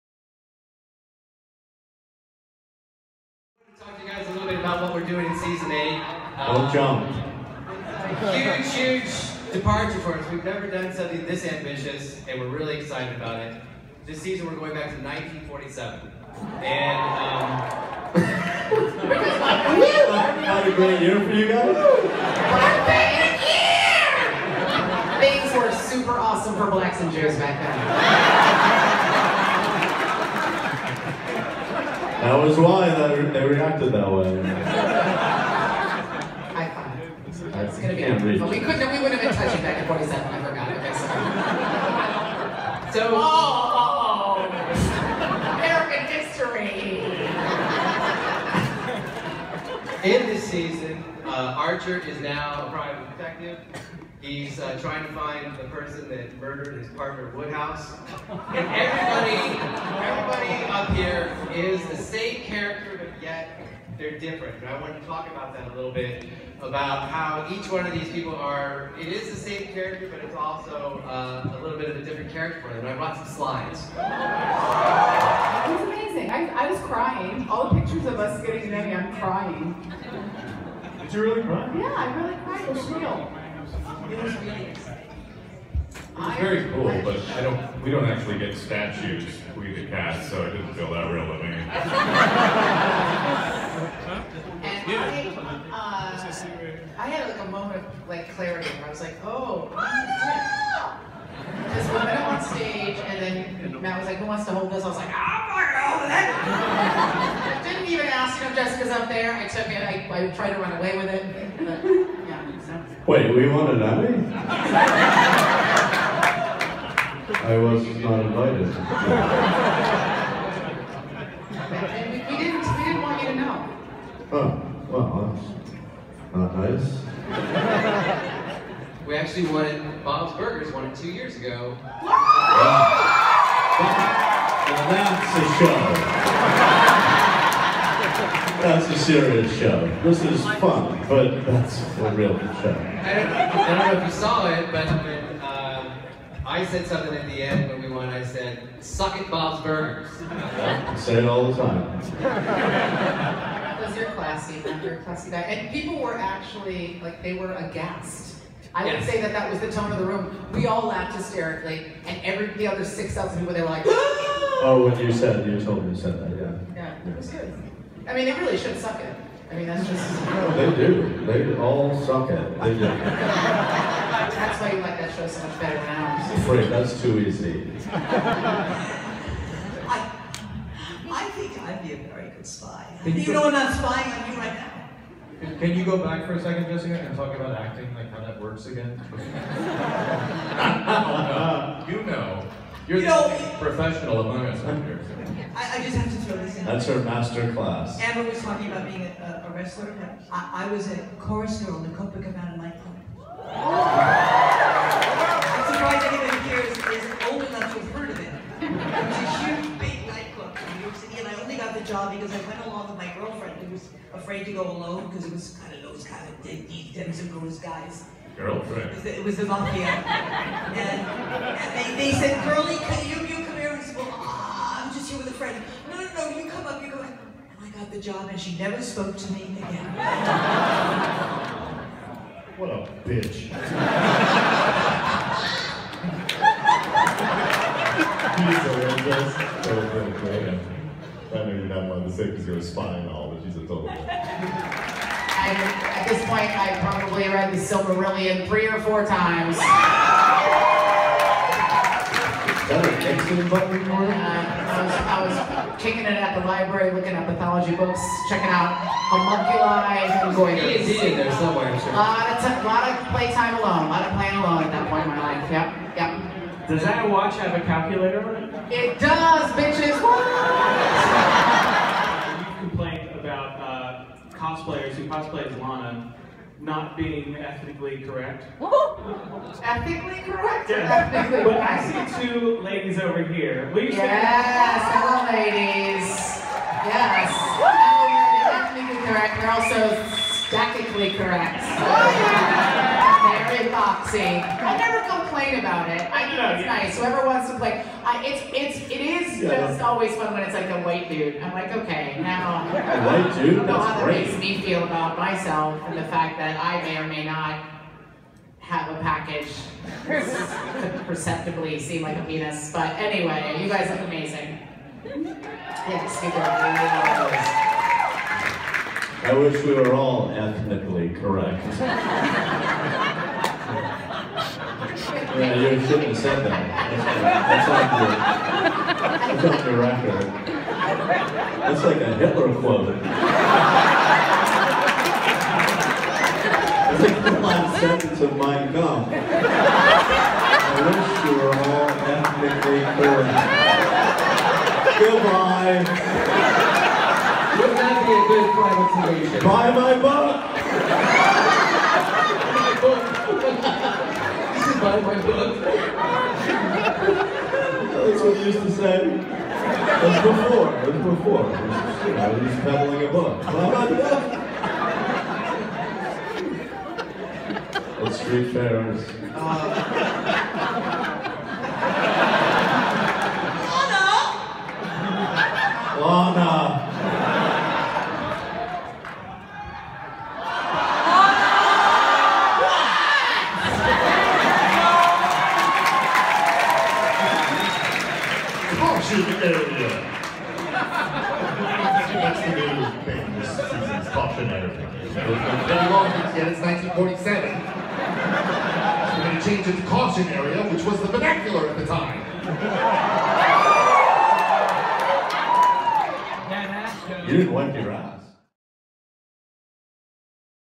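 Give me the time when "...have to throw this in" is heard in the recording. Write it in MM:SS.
03:15.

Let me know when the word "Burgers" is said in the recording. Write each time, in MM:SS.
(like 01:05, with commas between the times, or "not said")
02:10, 02:29.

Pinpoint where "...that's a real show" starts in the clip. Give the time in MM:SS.
02:21.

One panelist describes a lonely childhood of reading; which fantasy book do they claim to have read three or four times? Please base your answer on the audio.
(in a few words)
The Silmarillion.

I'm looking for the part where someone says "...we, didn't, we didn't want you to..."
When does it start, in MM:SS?
02:02.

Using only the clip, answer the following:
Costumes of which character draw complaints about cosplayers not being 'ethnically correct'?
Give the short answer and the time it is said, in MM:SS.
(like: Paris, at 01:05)
Lana, at 04:35.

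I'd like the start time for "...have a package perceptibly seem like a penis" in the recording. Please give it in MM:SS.
05:08.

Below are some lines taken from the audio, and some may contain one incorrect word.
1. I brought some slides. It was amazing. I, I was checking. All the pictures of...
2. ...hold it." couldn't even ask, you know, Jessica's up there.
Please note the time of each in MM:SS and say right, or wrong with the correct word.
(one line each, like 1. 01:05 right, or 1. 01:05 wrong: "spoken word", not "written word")
1. 01:12 wrong: "crying", not "checking"
2. 01:45 right.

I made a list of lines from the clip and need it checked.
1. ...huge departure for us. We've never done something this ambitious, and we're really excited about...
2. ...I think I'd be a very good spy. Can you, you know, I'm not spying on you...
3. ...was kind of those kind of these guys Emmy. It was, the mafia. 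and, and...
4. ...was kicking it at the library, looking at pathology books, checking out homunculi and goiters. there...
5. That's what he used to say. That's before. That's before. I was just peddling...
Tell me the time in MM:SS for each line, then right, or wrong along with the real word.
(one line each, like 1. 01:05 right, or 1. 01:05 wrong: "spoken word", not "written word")
1. 00:09 right
2. 03:01 right
3. 03:35 wrong: "Girlfriend", not "Emmy"
4. 04:15 right
5. 05:55 right.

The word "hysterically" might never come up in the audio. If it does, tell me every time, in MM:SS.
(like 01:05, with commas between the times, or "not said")
02:41.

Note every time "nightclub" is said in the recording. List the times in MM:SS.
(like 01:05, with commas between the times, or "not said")
03:22, 03:30.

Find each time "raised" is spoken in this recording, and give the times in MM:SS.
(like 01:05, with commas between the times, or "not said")
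not said.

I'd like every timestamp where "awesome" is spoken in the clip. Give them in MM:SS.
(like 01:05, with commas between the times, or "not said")
00:26.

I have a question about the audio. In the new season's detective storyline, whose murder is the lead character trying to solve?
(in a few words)
Woodhouse.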